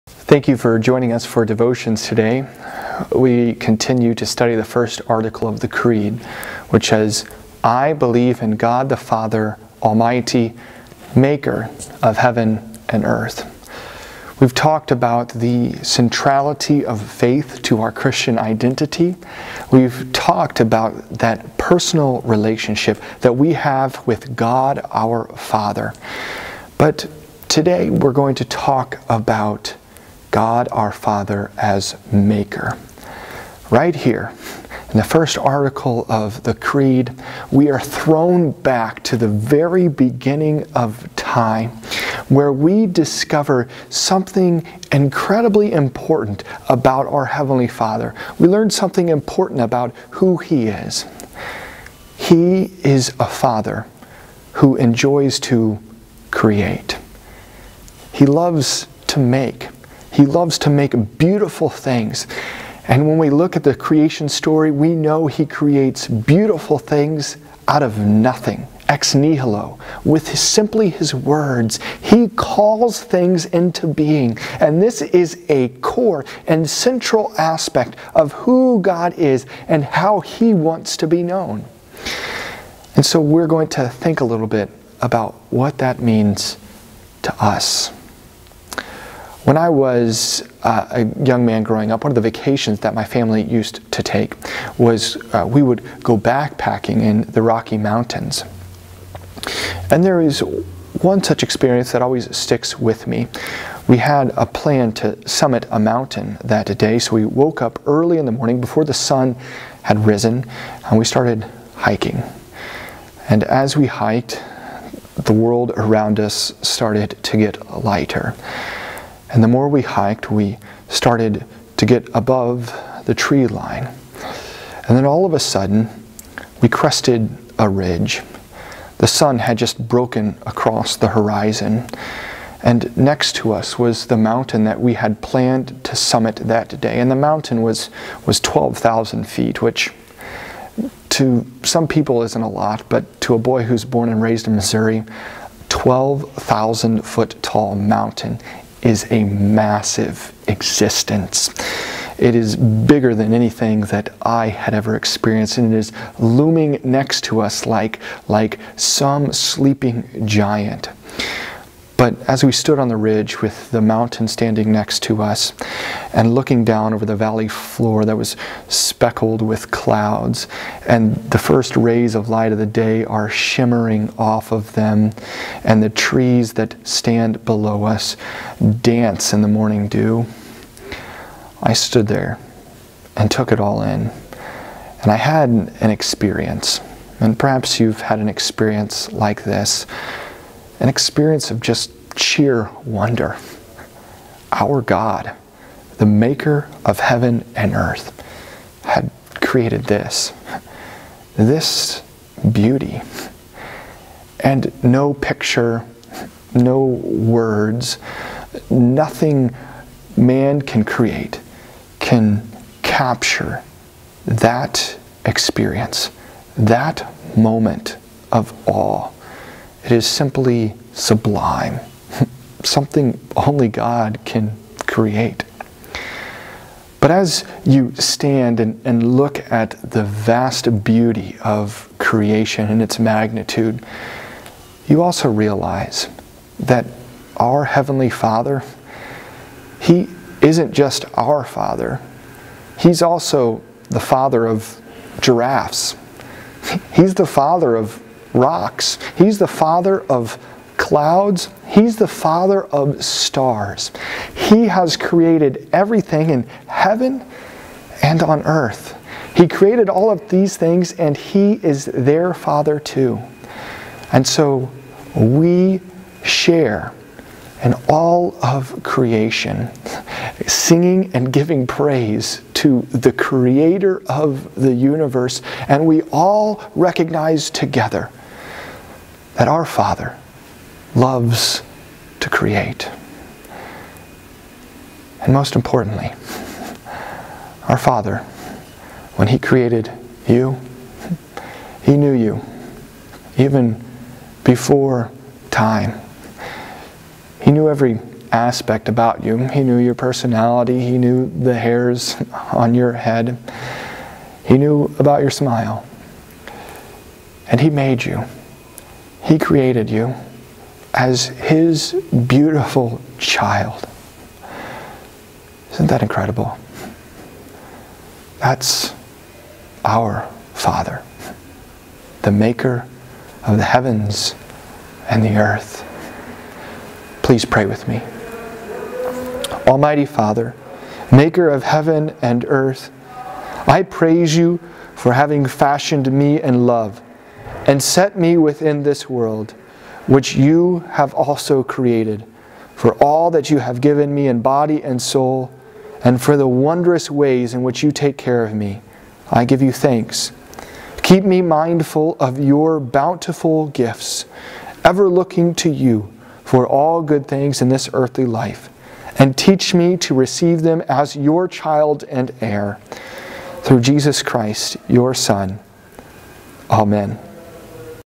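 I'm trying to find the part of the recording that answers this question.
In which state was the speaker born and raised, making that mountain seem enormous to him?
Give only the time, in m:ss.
2:24.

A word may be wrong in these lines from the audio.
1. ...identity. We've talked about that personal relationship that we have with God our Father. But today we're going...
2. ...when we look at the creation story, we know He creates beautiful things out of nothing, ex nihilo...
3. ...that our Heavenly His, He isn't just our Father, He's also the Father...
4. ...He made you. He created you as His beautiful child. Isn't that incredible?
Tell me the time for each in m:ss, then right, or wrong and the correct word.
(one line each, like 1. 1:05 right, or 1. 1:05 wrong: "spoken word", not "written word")
1. 0:18 right
2. 1:03 right
3. 3:56 wrong: "Father", not "His"
4. 5:07 right.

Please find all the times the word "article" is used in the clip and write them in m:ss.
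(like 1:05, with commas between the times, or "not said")
0:05, 0:35.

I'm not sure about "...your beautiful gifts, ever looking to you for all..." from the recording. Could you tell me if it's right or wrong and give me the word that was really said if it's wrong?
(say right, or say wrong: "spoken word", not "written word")
wrong: "bountiful", not "beautiful".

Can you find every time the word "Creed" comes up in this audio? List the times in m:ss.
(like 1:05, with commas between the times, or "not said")
0:05, 0:36.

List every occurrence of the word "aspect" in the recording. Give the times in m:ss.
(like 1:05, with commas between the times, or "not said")
1:17, 4:58.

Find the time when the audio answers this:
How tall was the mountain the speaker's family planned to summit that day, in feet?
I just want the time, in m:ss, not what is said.
2:18.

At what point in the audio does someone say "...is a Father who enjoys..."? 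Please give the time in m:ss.
0:52.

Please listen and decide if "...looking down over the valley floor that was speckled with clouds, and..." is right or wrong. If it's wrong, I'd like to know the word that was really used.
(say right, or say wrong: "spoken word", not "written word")
right.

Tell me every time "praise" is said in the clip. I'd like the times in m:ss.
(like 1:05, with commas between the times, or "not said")
4:31, 5:33.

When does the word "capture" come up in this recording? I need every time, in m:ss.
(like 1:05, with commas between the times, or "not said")
3:32.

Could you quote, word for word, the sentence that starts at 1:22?
And so we're going to think a little bit about what that means to us.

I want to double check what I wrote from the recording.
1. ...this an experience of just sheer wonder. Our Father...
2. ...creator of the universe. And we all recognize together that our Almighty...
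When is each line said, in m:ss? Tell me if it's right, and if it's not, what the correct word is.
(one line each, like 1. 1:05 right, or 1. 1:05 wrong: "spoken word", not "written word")
1. 3:09 wrong: "God", not "Father"
2. 4:33 wrong: "Father", not "Almighty".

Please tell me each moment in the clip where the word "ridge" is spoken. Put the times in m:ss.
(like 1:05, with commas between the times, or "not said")
2:07, 2:42.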